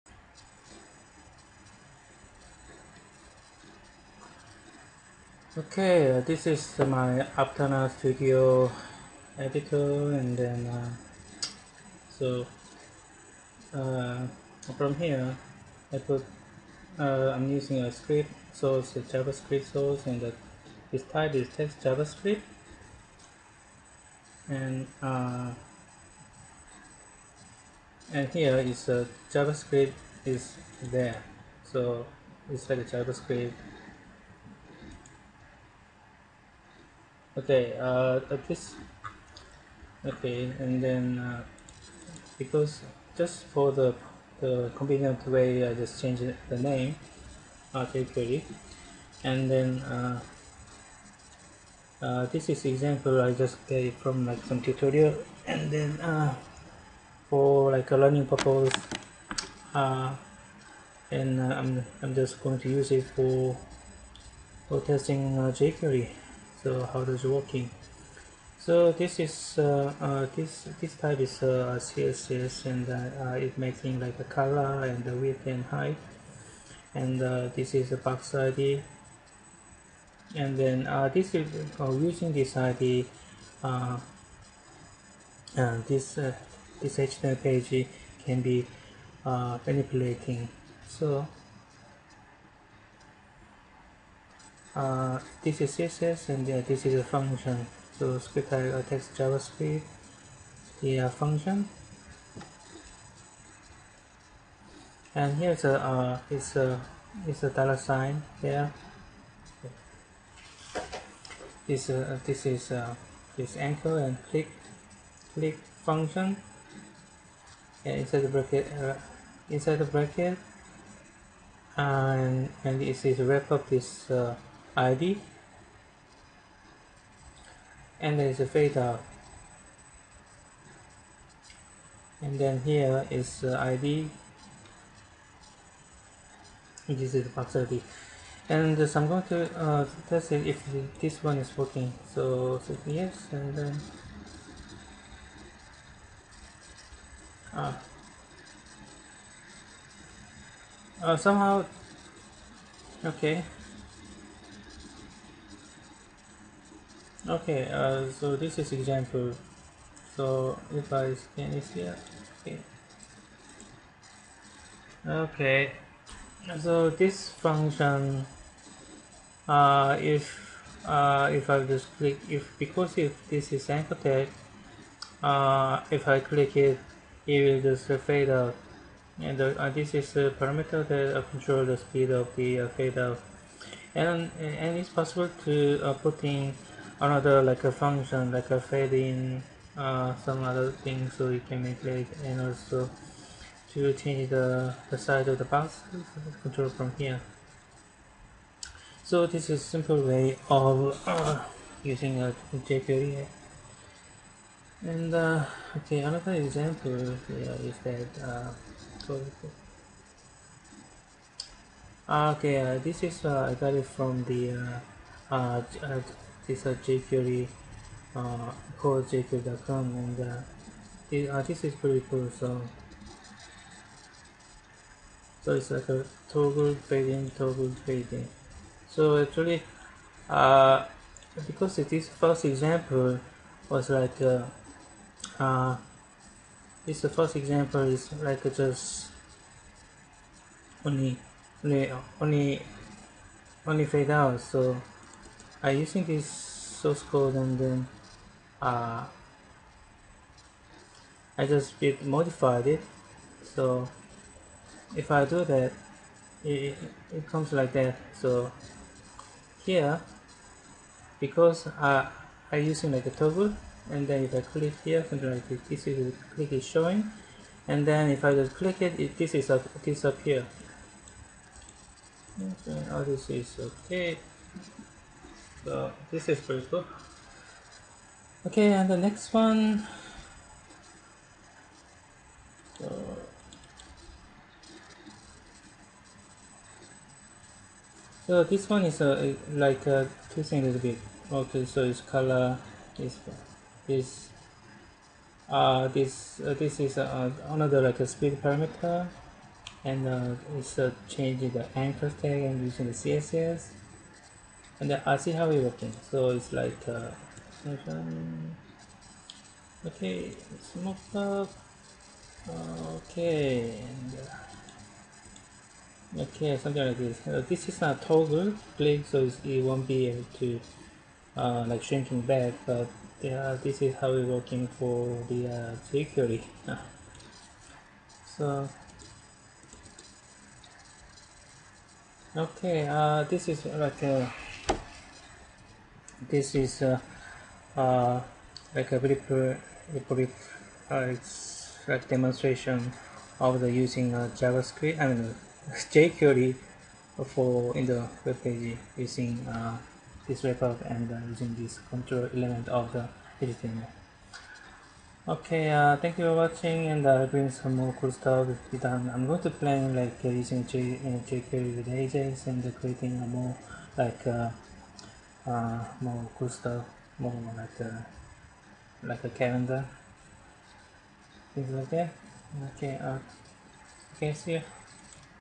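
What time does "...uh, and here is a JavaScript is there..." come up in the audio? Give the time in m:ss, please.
0:25.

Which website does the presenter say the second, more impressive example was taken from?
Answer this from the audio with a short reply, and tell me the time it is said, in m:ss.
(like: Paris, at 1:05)
core.jQuery.com, at 3:38.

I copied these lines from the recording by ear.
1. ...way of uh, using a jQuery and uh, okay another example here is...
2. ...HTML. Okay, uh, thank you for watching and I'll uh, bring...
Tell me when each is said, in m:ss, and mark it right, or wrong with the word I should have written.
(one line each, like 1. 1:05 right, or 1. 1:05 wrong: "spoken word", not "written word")
1. 3:20 right
2. 5:53 right.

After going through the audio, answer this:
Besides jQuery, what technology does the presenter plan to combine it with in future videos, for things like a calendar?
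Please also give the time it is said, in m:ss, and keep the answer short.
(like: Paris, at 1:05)
Ajax, at 6:01.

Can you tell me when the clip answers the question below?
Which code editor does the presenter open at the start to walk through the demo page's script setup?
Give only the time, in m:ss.
0:07.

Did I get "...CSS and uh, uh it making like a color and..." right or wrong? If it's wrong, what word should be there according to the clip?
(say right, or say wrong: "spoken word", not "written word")
right.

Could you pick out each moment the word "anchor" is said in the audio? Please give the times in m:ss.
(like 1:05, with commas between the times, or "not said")
1:53, 2:53, 5:01.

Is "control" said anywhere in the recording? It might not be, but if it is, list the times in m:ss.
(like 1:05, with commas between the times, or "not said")
3:01, 3:16, 5:51.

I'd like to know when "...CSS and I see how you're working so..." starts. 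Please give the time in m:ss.
5:02.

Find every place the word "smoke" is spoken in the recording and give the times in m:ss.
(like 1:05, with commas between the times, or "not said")
5:10.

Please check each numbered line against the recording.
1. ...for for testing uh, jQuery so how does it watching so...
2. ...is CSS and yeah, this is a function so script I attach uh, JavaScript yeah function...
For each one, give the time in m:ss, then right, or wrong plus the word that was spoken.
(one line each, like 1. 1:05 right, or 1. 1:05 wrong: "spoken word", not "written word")
1. 1:03 wrong: "working", not "watching"
2. 1:35 right.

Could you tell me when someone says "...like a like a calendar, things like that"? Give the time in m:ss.
6:07.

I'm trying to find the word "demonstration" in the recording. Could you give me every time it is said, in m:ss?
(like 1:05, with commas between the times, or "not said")
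5:42.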